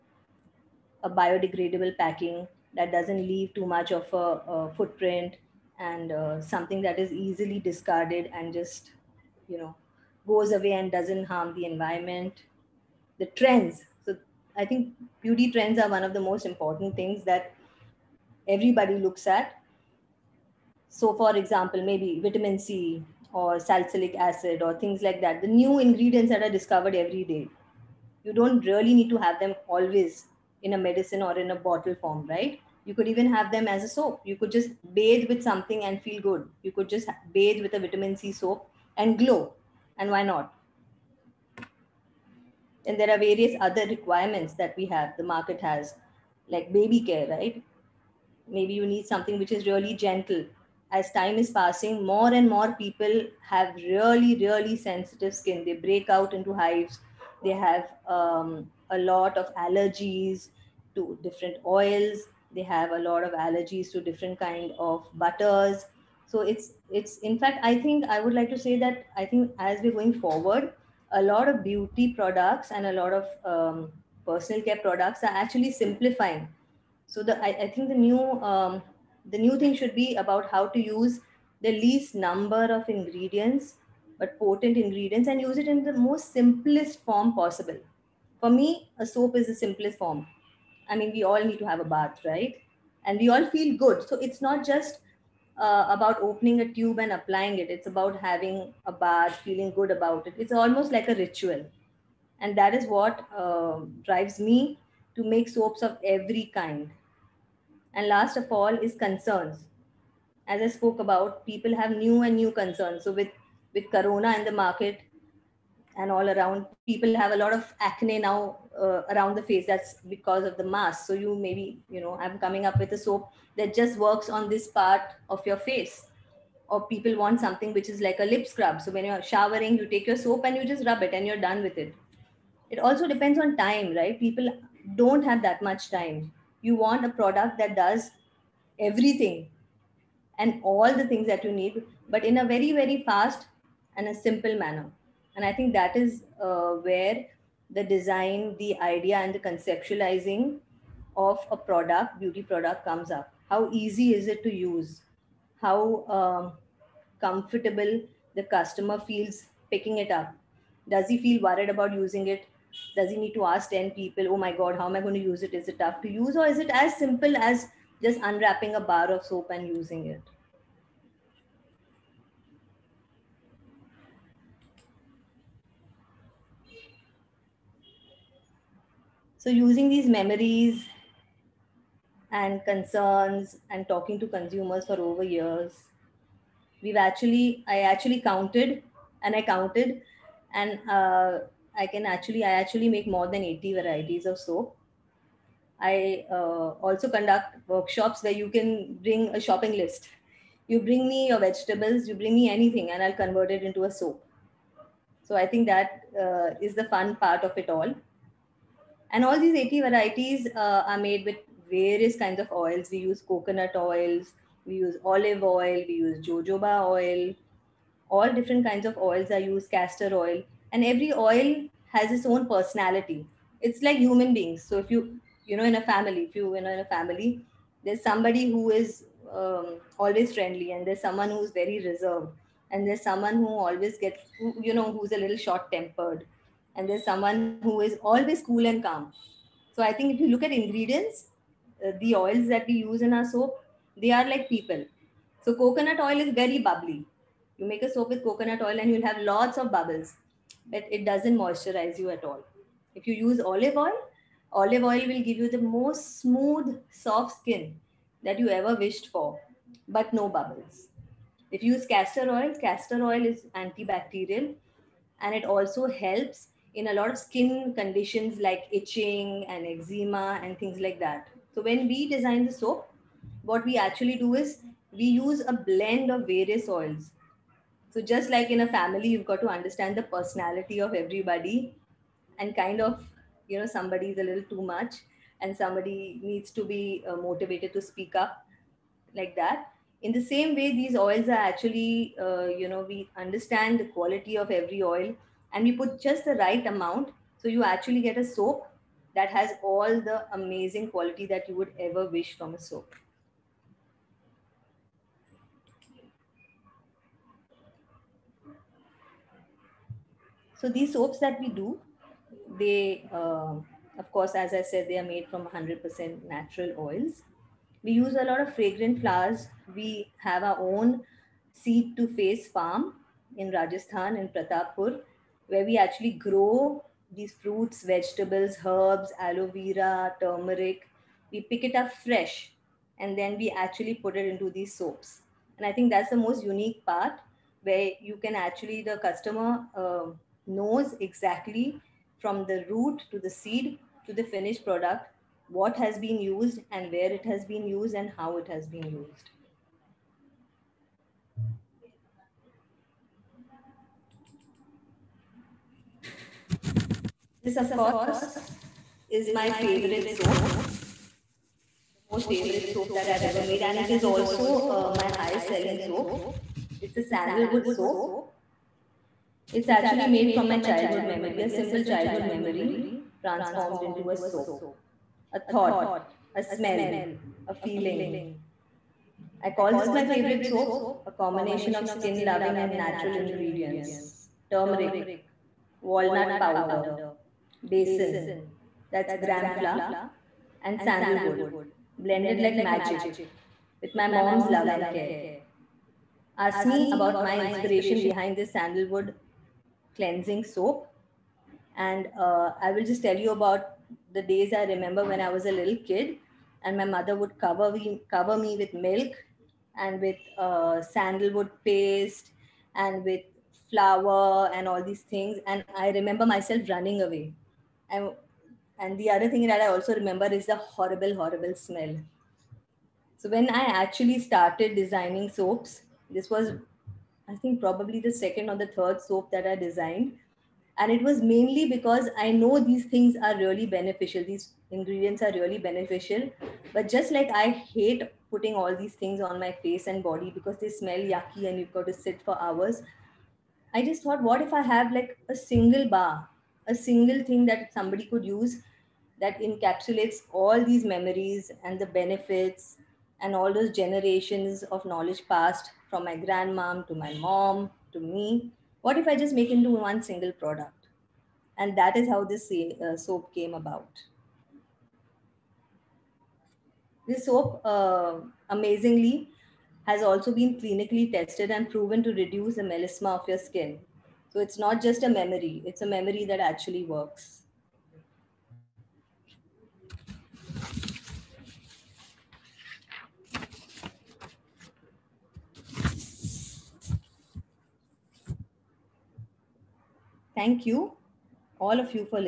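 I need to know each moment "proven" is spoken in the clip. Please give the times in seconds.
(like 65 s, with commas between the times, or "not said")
471 s.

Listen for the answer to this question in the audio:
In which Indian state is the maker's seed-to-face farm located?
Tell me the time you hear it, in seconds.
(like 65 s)
323 s.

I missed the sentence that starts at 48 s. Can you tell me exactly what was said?
Maybe you need something which is really gentle.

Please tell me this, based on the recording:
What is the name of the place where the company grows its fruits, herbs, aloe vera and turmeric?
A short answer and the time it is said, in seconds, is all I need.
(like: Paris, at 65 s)
Pratapur, at 324 s.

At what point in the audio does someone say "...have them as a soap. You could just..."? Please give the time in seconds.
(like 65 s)
33 s.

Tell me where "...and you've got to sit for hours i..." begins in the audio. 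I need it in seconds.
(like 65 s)
441 s.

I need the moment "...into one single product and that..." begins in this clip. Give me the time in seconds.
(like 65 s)
459 s.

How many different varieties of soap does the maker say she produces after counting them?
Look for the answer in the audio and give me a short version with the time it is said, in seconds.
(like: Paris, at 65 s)
More than 80, at 193 s.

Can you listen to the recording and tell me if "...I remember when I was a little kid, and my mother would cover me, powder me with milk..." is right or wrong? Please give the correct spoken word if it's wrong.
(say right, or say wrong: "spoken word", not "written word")
wrong: "cover", not "powder".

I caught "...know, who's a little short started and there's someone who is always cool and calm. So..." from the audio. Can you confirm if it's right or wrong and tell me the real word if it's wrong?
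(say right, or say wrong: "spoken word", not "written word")
wrong: "tempered", not "started".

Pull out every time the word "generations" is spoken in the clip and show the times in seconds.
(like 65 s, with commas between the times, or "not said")
453 s.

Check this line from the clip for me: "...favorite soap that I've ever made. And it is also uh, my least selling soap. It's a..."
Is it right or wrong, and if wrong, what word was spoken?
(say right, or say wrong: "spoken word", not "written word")
wrong: "highest", not "least".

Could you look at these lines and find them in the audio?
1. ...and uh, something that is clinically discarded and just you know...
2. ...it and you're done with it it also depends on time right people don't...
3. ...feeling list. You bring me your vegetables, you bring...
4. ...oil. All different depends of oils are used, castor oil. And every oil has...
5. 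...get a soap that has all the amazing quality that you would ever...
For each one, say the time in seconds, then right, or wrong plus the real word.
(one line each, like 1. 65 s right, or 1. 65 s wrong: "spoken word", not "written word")
1. 5 s wrong: "easily", not "clinically"
2. 131 s right
3. 199 s wrong: "shopping", not "feeling"
4. 216 s wrong: "kinds", not "depends"
5. 298 s right.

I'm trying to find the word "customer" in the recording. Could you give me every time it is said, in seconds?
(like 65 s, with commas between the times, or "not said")
158 s, 338 s.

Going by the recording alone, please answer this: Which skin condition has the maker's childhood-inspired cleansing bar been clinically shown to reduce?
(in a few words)
Melasma.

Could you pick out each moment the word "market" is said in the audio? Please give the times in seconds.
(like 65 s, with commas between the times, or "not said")
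45 s, 114 s.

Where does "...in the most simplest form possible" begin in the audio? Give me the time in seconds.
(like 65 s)
85 s.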